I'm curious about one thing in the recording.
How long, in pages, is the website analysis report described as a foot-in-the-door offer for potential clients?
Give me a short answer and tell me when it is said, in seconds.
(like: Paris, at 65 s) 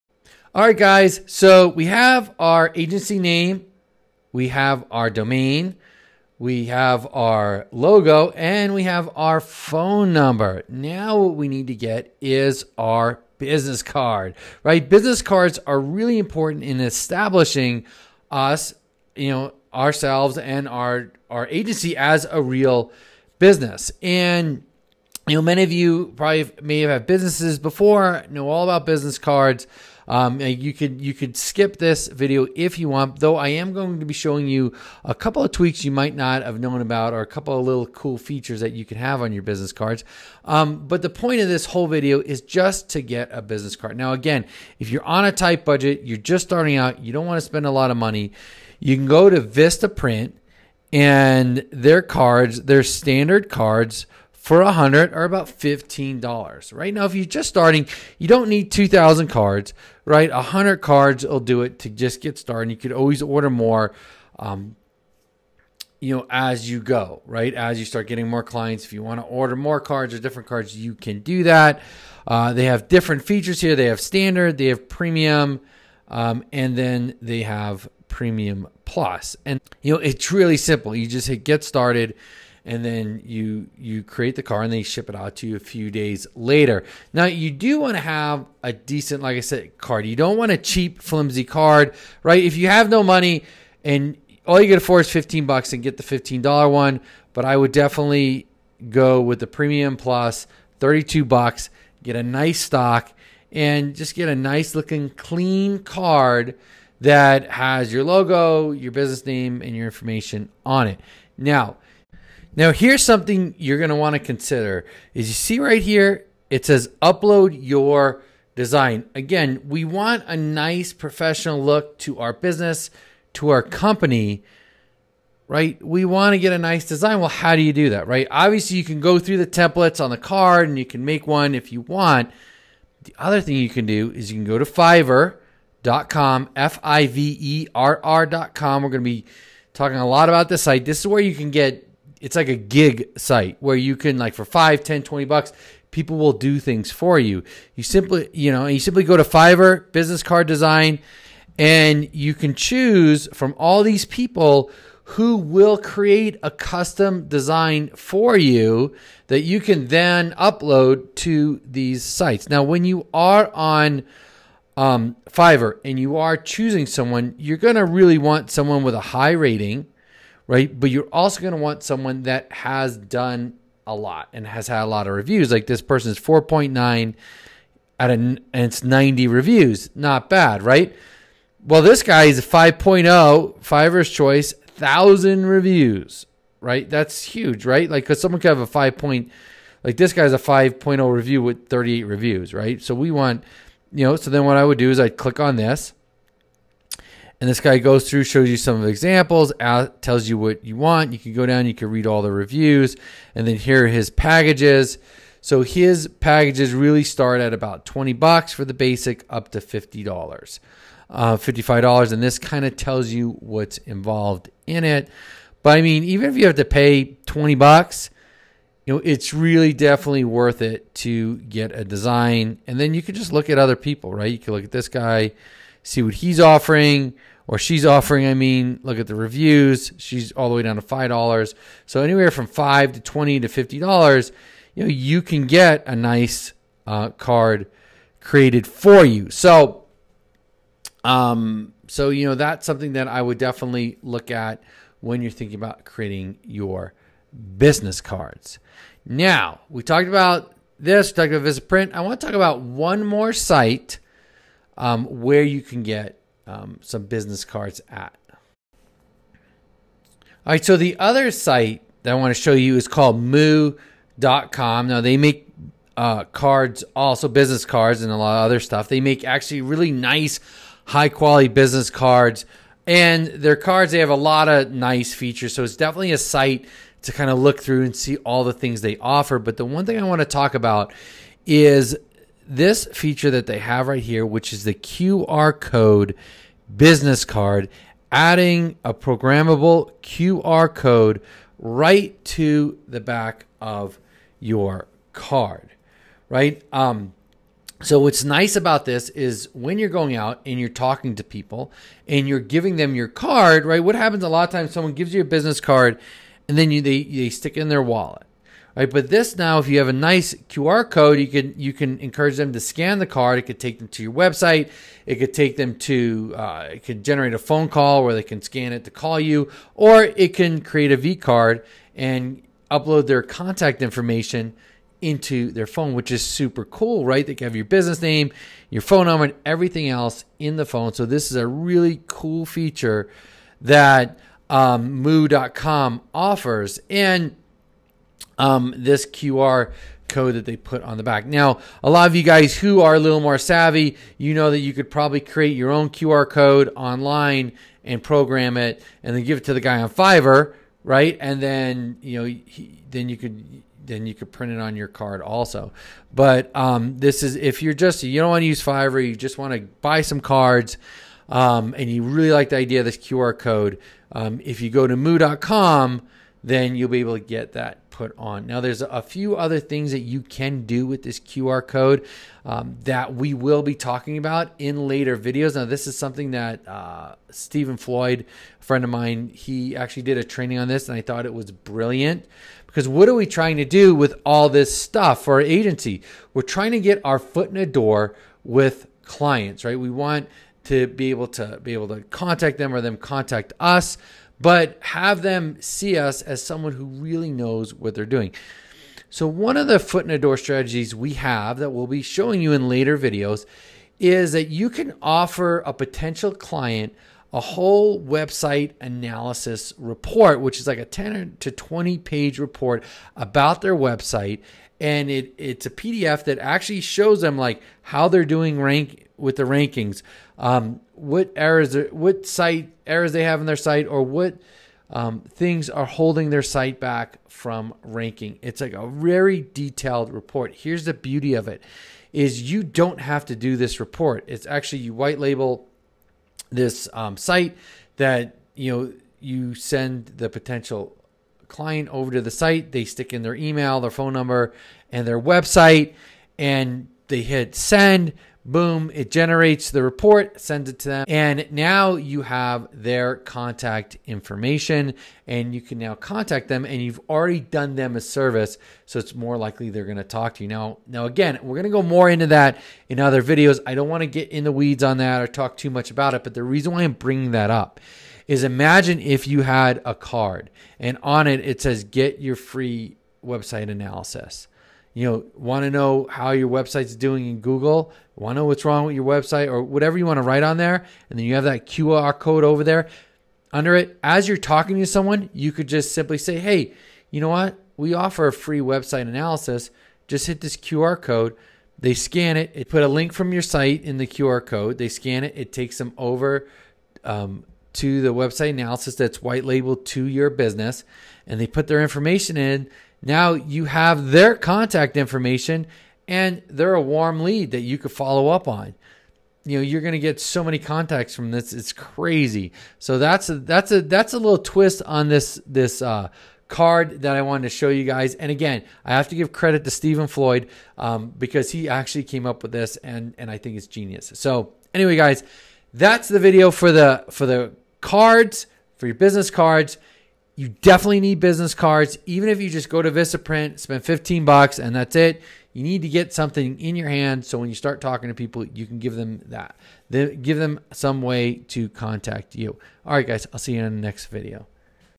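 10 to 20 pages, at 410 s.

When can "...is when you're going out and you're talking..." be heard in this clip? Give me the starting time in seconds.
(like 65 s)
299 s.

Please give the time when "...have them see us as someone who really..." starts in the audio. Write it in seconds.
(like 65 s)
394 s.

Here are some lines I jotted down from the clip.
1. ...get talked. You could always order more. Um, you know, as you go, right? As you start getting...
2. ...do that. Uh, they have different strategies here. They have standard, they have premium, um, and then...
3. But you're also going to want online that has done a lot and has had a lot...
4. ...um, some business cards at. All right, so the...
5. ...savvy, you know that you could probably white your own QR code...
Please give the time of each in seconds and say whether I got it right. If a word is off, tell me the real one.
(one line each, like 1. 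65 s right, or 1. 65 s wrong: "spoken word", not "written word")
1. 62 s wrong: "started", not "talked"
2. 71 s wrong: "features", not "strategies"
3. 170 s wrong: "someone", not "online"
4. 256 s right
5. 343 s wrong: "create", not "white".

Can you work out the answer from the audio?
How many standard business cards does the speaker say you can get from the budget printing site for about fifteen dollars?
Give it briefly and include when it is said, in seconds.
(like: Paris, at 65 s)
100, at 54 s.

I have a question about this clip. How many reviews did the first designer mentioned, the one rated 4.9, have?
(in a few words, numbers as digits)
90.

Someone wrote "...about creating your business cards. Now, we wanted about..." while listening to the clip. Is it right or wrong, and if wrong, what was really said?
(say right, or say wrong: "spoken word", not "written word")
wrong: "talked", not "wanted".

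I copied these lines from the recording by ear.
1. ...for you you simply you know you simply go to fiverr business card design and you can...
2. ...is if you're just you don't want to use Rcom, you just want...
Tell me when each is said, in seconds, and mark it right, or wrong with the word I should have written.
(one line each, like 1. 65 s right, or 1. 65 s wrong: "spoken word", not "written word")
1. 146 s right
2. 357 s wrong: "Fiverr", not "Rcom".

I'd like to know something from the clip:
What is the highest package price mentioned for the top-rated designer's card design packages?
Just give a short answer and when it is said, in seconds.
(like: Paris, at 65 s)
$55, at 211 s.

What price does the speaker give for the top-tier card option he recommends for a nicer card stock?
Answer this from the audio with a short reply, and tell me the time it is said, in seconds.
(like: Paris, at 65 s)
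$32, at 100 s.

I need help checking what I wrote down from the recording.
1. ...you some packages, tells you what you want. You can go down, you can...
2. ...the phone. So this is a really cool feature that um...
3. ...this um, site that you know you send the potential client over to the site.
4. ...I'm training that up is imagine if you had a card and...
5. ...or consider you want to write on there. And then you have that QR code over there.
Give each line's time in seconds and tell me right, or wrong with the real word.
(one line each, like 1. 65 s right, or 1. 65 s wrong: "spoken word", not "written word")
1. 198 s wrong: "examples", not "packages"
2. 330 s right
3. 436 s right
4. 466 s wrong: "bringing", not "training"
5. 479 s wrong: "whatever", not "consider".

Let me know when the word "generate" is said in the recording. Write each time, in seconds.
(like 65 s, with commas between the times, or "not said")
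317 s, 449 s.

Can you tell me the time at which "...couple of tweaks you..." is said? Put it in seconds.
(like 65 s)
35 s.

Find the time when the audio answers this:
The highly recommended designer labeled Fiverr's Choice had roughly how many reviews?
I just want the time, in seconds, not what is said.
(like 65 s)
184 s.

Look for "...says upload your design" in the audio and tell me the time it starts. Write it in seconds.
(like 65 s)
116 s.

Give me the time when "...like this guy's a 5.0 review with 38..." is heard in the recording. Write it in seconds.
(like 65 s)
189 s.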